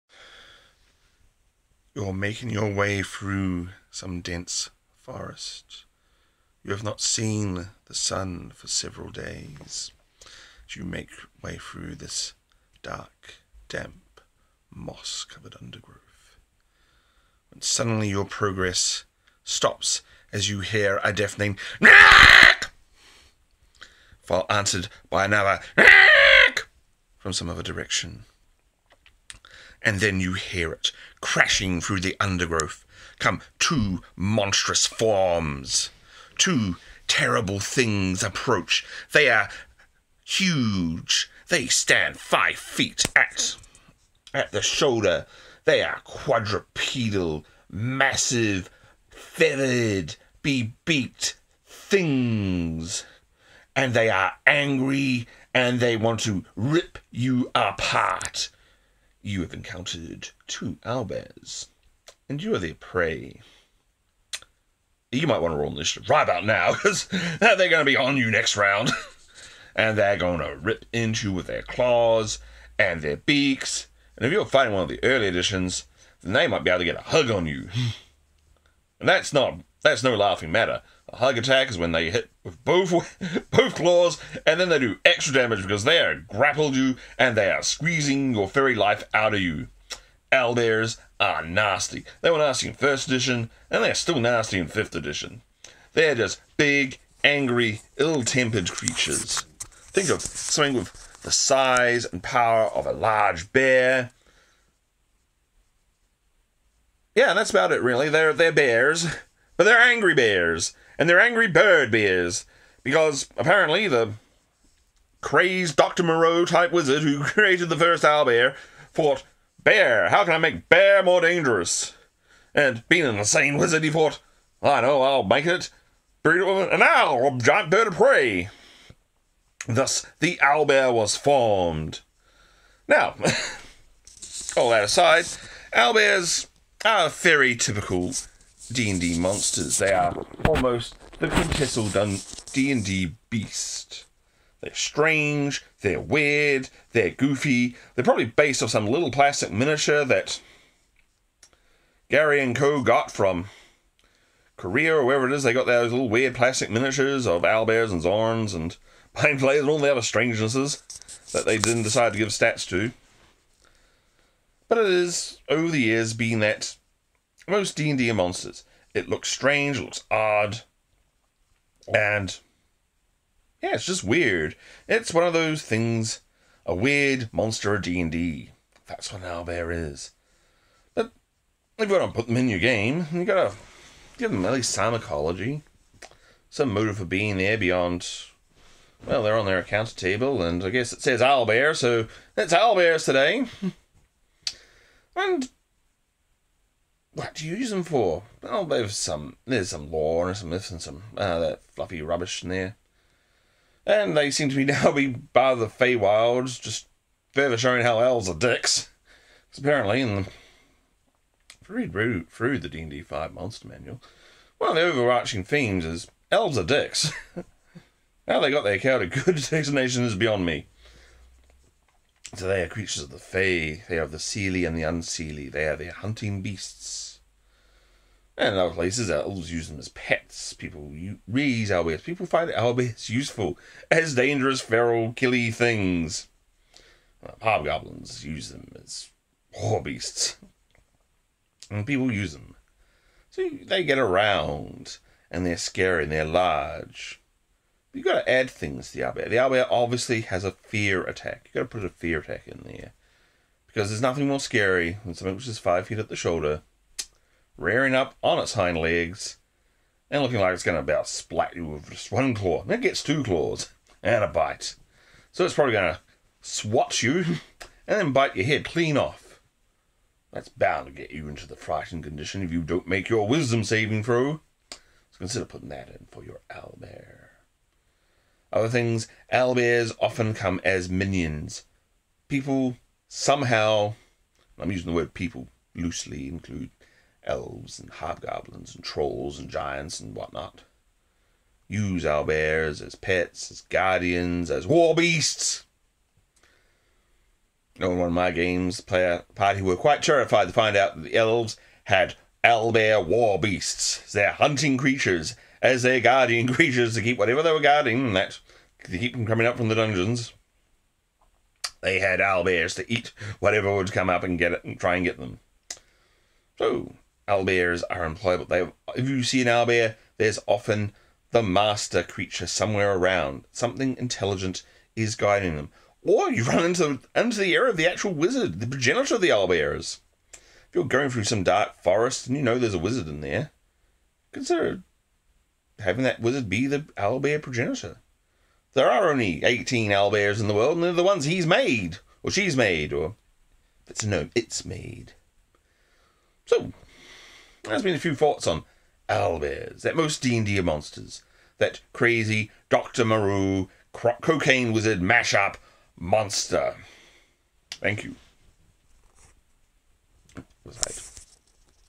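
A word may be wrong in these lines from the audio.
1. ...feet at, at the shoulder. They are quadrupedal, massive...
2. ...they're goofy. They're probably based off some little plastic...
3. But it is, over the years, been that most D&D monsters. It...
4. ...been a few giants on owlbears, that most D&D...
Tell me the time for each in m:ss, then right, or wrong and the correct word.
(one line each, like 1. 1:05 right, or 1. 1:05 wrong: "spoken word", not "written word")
1. 0:42 right
2. 2:26 right
3. 2:44 right
4. 5:47 wrong: "thoughts", not "giants".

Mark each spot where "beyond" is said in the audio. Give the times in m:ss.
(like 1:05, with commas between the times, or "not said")
3:07, 3:40.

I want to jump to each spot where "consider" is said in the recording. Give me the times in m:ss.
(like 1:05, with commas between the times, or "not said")
4:35, 5:34.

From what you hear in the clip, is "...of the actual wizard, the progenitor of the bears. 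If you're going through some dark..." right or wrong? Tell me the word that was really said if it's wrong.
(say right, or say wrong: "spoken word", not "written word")
wrong: "owlbears", not "bears".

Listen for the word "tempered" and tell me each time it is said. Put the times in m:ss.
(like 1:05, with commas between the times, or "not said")
1:37.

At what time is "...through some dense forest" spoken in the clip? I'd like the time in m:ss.
0:03.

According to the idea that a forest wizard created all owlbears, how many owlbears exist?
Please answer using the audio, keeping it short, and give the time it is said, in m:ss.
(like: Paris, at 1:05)
18, at 5:39.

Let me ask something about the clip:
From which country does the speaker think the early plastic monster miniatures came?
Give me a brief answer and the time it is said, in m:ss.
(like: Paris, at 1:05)
Korea, at 2:34.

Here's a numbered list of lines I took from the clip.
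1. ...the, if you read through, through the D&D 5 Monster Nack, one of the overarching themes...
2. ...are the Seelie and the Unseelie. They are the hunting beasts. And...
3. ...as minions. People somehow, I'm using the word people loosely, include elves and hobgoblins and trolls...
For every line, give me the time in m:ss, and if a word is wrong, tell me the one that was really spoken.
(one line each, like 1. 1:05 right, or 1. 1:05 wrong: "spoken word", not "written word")
1. 3:30 wrong: "Manual", not "Nack"
2. 3:43 right
3. 4:40 right.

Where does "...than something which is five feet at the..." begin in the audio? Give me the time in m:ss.
4:15.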